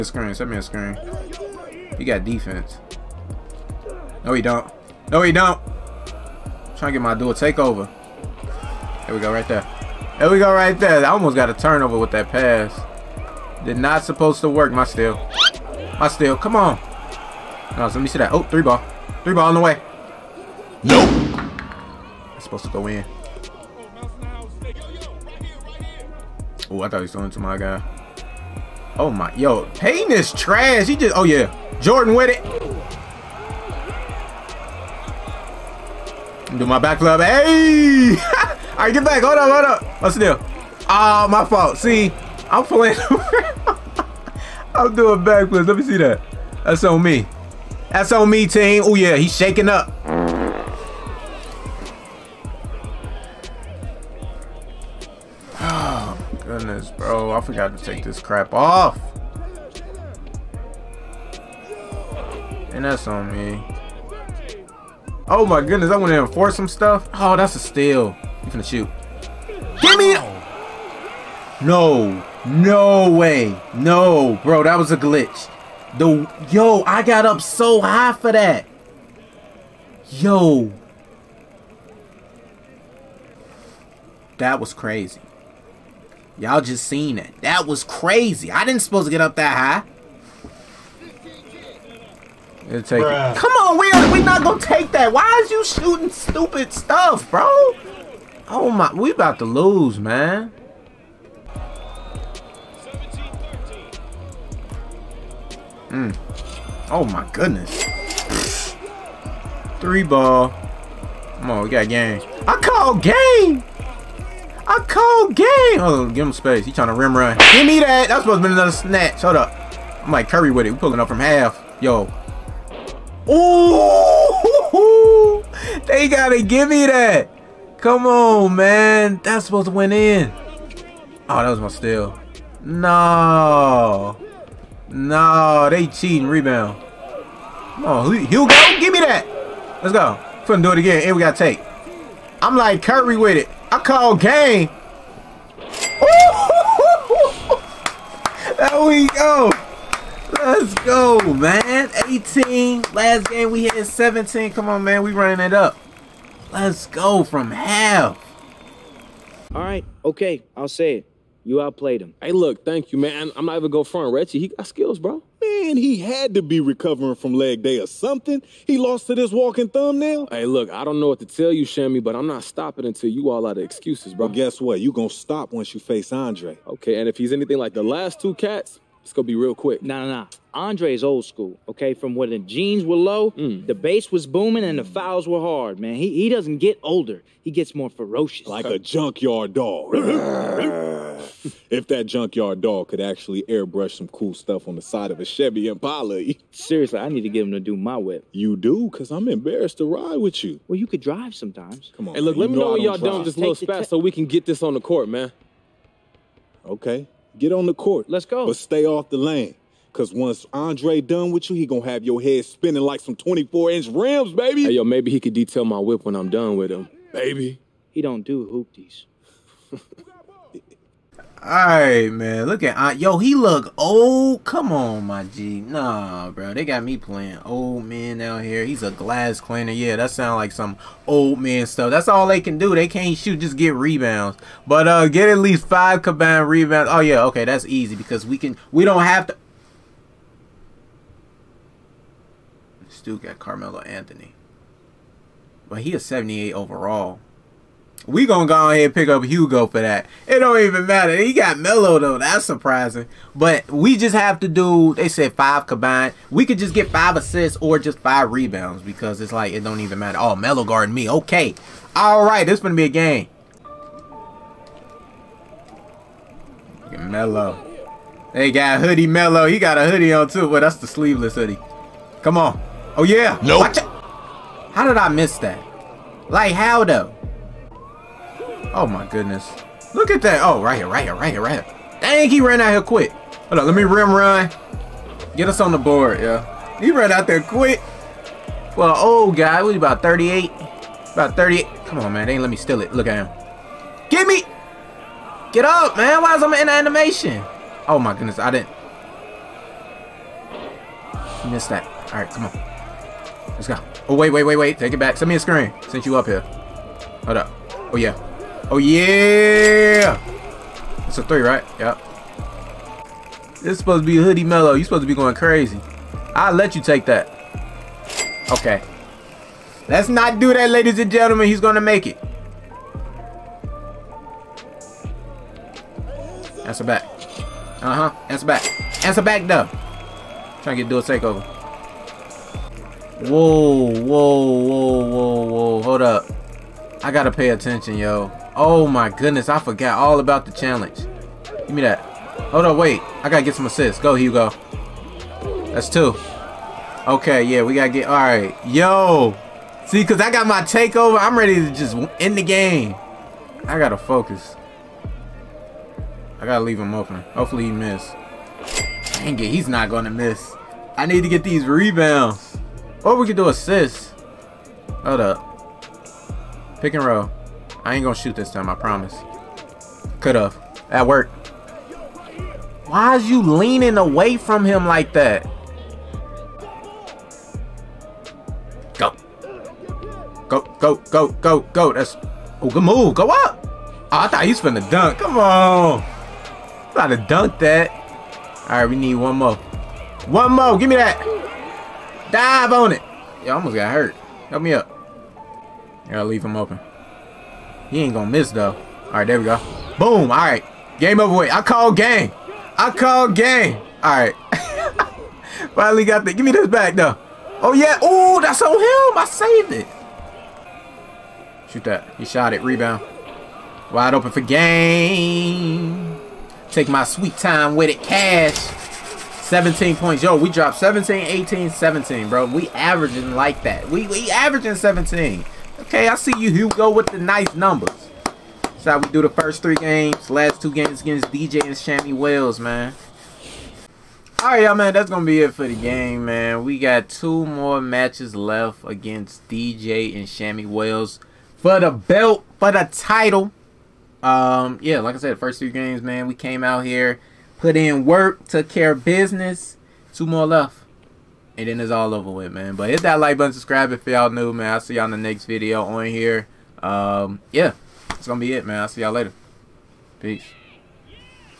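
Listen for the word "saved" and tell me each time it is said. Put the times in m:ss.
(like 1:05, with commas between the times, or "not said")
6:49.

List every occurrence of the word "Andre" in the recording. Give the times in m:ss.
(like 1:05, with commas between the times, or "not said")
2:56, 3:30.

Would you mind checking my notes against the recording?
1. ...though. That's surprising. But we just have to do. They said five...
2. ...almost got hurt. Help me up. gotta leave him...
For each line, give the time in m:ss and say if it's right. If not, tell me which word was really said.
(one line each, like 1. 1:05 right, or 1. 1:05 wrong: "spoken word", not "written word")
1. 4:11 right
2. 6:33 right.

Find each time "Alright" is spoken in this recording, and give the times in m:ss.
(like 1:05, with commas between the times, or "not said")
3:41, 5:48.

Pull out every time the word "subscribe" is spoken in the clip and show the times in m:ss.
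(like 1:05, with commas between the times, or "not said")
7:33.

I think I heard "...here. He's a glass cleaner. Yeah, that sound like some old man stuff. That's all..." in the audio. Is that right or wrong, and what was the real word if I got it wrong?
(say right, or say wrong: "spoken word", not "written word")
right.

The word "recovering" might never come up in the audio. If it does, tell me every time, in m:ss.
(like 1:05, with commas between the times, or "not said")
2:46.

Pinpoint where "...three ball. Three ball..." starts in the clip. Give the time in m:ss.
0:18.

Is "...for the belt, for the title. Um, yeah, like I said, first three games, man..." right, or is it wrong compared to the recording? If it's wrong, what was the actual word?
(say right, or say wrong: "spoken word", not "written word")
right.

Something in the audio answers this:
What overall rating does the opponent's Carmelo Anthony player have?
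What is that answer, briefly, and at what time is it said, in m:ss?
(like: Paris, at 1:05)
78, at 4:06.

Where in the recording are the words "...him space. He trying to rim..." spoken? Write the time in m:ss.
1:56.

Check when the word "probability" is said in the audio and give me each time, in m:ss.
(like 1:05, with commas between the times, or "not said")
not said.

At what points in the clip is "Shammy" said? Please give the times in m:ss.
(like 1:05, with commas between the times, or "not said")
2:51, 7:11, 7:20.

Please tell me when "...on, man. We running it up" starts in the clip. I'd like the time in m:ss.
2:34.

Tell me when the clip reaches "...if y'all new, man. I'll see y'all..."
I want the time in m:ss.
7:33.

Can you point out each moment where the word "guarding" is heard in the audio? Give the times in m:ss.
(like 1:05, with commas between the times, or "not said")
4:20.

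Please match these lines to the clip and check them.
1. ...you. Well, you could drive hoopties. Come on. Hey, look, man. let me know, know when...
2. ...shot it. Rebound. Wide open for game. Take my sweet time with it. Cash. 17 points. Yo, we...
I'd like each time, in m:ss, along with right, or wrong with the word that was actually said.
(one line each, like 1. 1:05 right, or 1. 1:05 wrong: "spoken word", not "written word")
1. 3:20 wrong: "sometimes", not "hoopties"
2. 6:52 right.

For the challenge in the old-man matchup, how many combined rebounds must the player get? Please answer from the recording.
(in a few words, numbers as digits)
5.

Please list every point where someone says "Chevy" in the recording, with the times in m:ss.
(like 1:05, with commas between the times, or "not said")
3:15.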